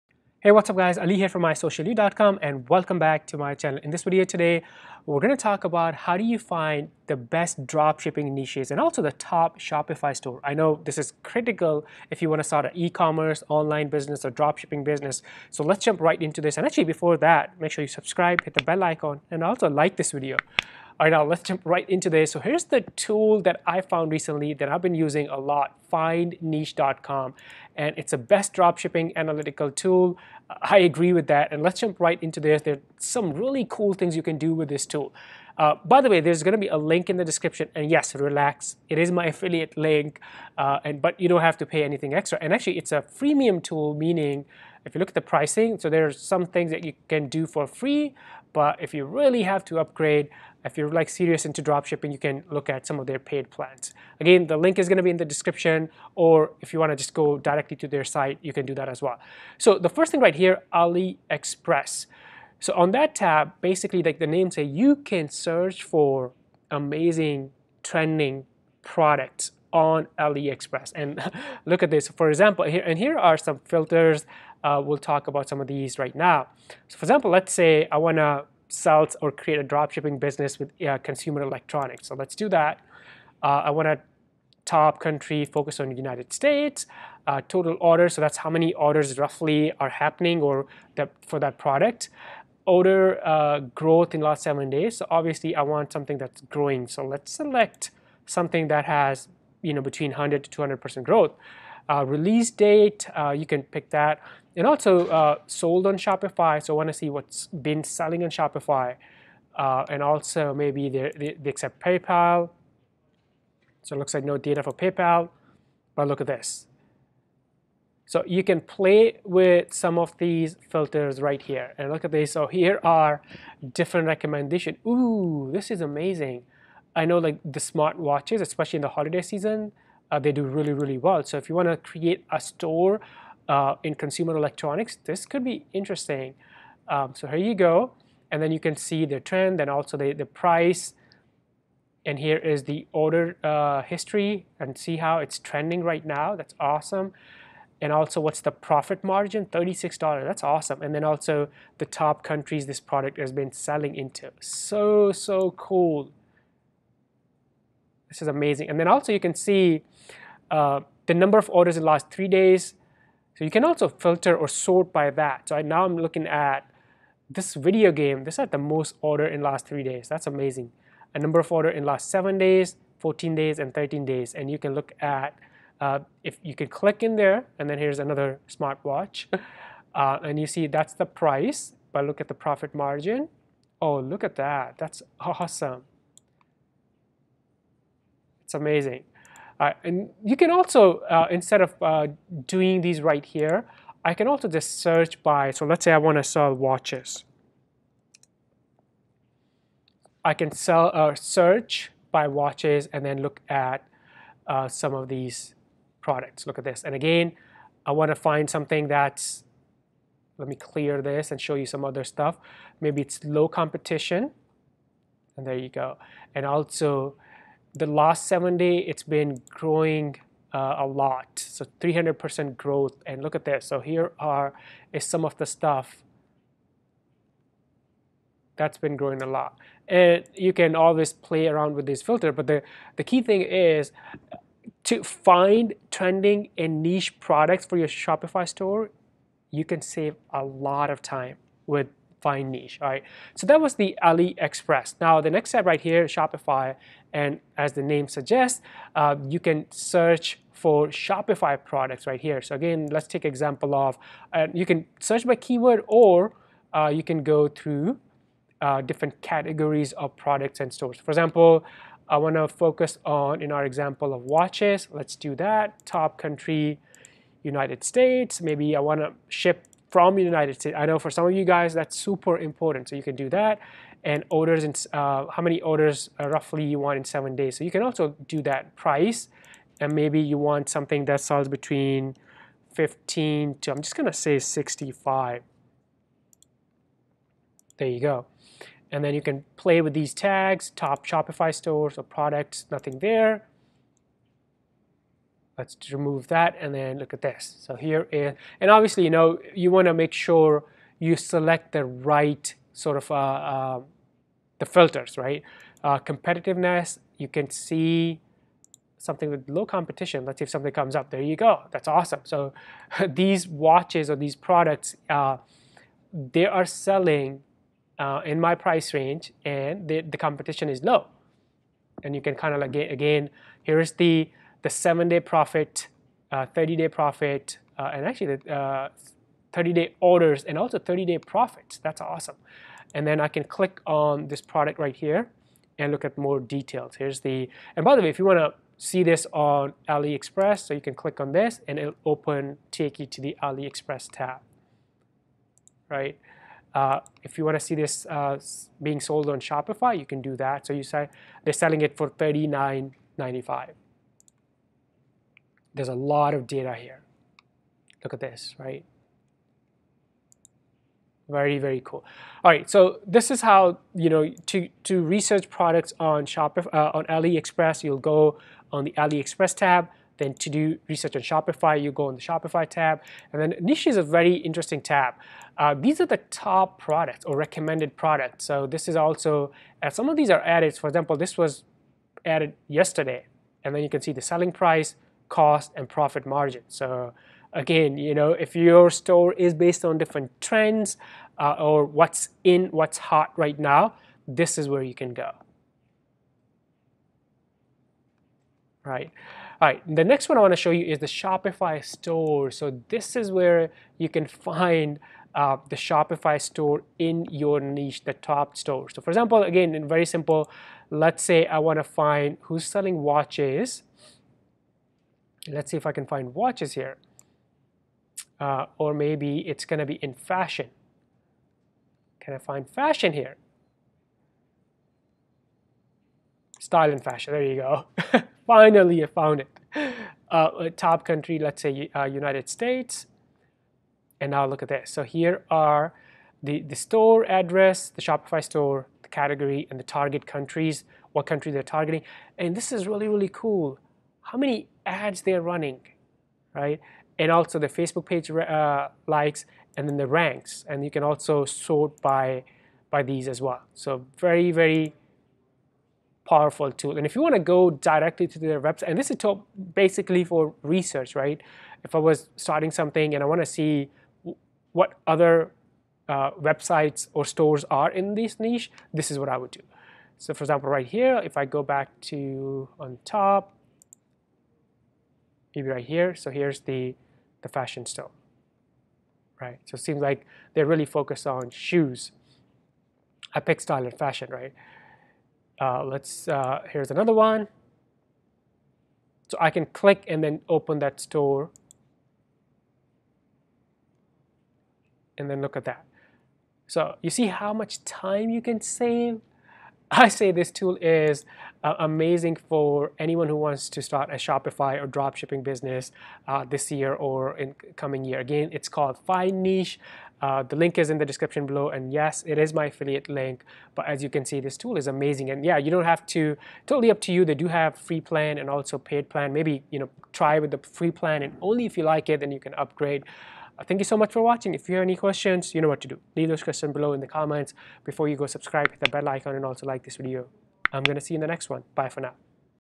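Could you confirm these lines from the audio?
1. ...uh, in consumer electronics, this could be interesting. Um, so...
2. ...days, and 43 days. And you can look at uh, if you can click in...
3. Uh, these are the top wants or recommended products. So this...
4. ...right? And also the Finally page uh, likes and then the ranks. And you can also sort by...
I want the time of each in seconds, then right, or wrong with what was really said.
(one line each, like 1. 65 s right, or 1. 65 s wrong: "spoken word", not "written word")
1. 133 s right
2. 173 s wrong: "13", not "43"
3. 375 s wrong: "products", not "wants"
4. 446 s wrong: "Facebook", not "Finally".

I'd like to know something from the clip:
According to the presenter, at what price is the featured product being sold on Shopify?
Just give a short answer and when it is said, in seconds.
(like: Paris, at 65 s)
$39.95, at 352 s.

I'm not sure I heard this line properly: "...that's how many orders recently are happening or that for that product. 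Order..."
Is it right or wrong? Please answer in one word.
wrong.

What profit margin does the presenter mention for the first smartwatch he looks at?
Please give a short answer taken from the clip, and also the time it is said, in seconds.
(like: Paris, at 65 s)
$36, at 149 s.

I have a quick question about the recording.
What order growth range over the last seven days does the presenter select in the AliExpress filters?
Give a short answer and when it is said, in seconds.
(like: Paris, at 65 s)
100 to 200%, at 100 s.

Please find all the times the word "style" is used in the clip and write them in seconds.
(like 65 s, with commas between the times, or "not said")
426 s, 483 s.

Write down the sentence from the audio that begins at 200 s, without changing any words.
I can sell, uh, search by watches and then look at uh, some of these products.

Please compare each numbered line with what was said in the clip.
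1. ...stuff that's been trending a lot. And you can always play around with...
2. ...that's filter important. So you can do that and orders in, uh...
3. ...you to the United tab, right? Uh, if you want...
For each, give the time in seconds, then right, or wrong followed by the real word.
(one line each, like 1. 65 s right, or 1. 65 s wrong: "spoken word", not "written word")
1. 225 s wrong: "growing", not "trending"
2. 271 s wrong: "super", not "filter"
3. 342 s wrong: "AliExpress", not "United".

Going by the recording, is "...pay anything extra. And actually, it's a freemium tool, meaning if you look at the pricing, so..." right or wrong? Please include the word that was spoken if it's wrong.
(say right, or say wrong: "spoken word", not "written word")
right.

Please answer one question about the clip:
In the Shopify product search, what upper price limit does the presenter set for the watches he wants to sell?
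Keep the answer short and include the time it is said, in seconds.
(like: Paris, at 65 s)
65, at 284 s.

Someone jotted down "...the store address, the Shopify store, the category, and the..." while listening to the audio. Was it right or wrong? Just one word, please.
right.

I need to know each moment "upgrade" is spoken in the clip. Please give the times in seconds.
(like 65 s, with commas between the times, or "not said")
49 s, 522 s.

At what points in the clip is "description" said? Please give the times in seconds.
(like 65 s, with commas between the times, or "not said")
37 s, 55 s, 511 s.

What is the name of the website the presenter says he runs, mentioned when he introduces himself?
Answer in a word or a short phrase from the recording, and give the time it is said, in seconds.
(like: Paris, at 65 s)
isocialyou.com, at 1 s.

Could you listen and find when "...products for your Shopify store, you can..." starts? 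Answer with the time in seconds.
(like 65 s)
237 s.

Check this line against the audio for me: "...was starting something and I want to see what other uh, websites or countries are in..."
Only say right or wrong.
wrong.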